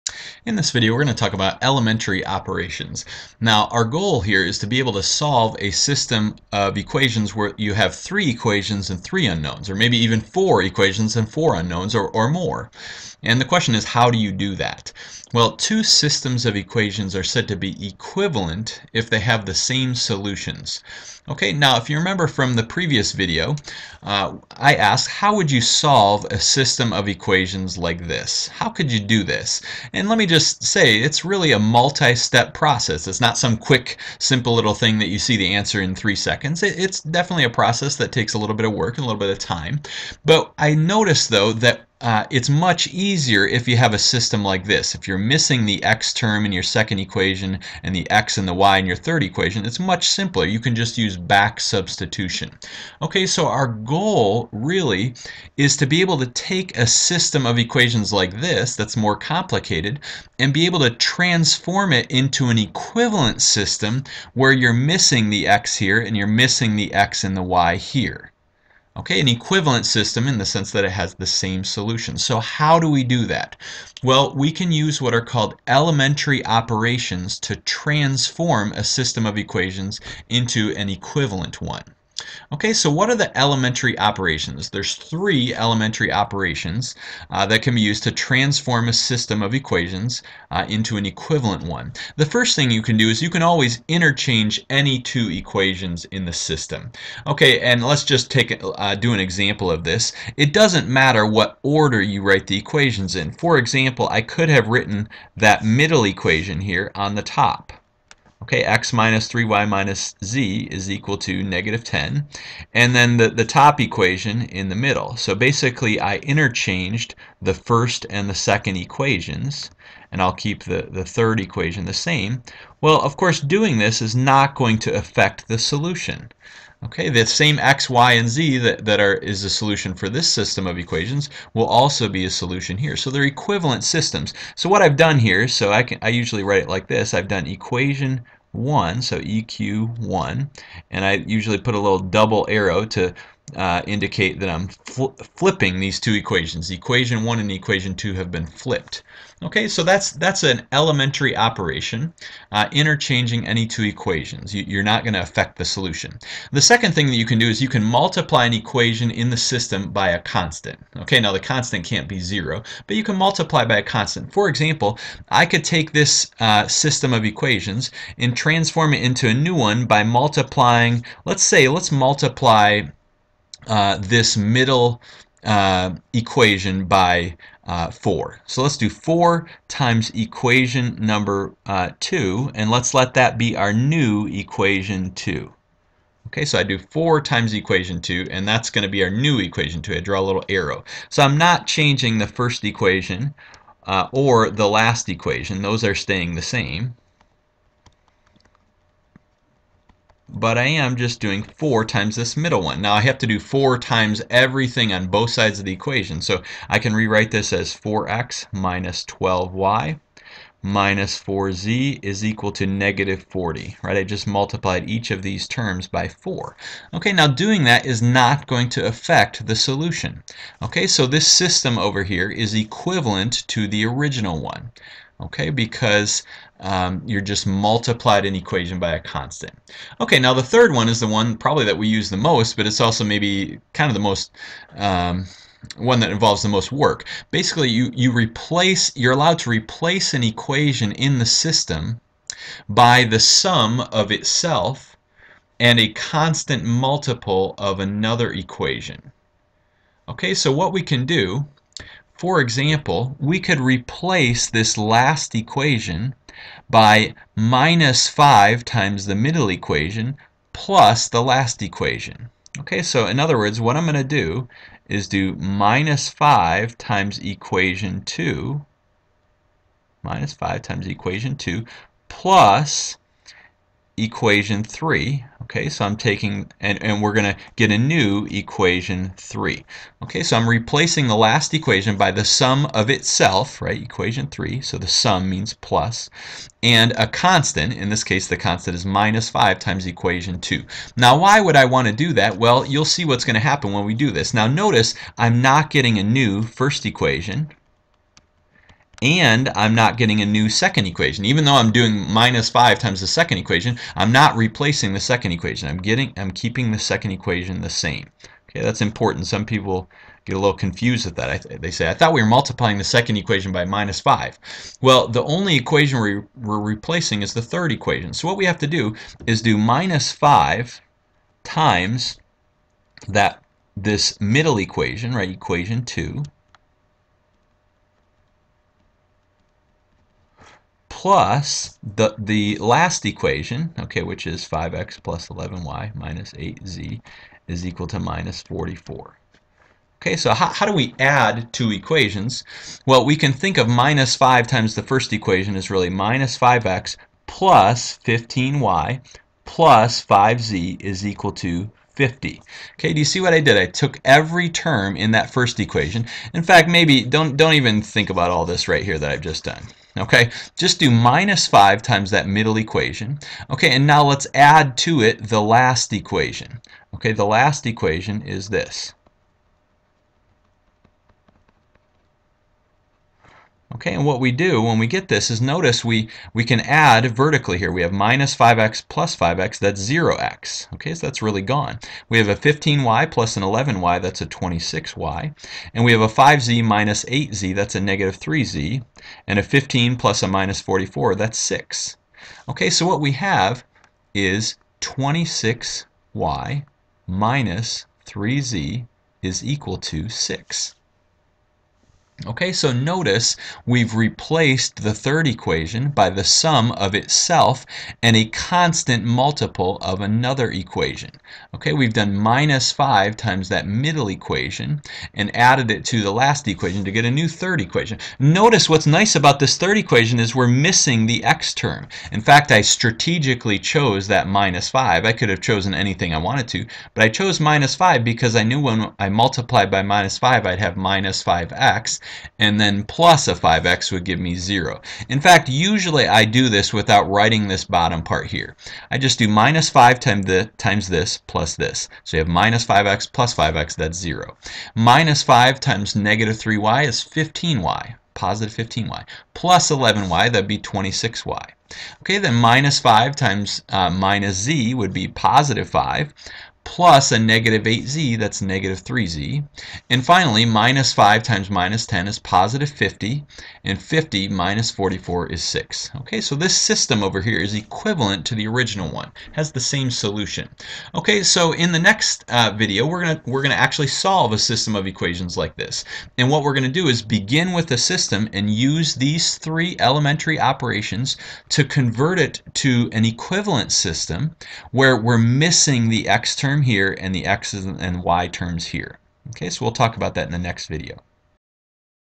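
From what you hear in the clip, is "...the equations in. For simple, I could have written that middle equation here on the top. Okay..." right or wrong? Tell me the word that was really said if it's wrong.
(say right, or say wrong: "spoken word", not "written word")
wrong: "example", not "simple".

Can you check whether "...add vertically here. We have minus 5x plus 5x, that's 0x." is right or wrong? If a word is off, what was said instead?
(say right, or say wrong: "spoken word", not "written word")
right.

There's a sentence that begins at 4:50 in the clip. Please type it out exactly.
Now why would I want to do that?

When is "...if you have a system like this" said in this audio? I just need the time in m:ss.
0:43.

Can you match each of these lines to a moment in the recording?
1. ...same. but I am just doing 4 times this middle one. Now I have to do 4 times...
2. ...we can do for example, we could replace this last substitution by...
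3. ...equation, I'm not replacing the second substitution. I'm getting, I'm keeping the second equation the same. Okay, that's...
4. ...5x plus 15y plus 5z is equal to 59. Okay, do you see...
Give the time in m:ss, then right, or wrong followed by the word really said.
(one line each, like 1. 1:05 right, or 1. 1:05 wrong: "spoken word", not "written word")
1. 3:16 right
2. 4:10 wrong: "equation", not "substitution"
3. 5:03 wrong: "equation", not "substitution"
4. 5:46 wrong: "50", not "59".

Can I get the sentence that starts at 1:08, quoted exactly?
Okay, an equivalent system in the sense that it has the same solution.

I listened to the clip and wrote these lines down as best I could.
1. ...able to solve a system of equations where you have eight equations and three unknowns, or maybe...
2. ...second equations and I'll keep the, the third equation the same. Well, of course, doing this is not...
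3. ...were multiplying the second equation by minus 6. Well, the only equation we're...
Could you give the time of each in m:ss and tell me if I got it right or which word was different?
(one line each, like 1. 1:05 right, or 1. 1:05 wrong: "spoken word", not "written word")
1. 0:04 wrong: "three", not "eight"
2. 1:58 right
3. 5:12 wrong: "5", not "6".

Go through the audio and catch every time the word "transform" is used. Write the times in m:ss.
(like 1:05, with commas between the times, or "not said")
1:00, 1:17, 1:28, 2:48.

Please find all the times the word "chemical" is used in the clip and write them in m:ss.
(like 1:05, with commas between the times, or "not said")
not said.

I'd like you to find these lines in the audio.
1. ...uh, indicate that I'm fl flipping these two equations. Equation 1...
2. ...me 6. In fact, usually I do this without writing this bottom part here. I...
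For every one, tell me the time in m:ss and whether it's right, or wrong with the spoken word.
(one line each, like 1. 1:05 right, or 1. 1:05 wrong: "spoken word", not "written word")
1. 2:23 right
2. 7:14 wrong: "0", not "6".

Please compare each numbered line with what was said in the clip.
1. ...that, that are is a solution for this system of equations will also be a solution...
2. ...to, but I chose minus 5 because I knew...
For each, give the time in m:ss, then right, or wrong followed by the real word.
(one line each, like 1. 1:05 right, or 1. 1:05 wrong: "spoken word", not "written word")
1. 2:08 right
2. 7:06 right.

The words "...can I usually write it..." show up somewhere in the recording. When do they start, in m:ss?
2:15.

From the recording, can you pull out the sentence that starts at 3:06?
Okay, so I do 4 times equation 2, and that's going to be our new equation 2.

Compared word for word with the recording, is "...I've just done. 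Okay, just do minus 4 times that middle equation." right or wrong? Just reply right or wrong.
wrong.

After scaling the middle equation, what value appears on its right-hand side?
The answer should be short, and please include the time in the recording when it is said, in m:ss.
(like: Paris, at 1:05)
-40, at 3:32.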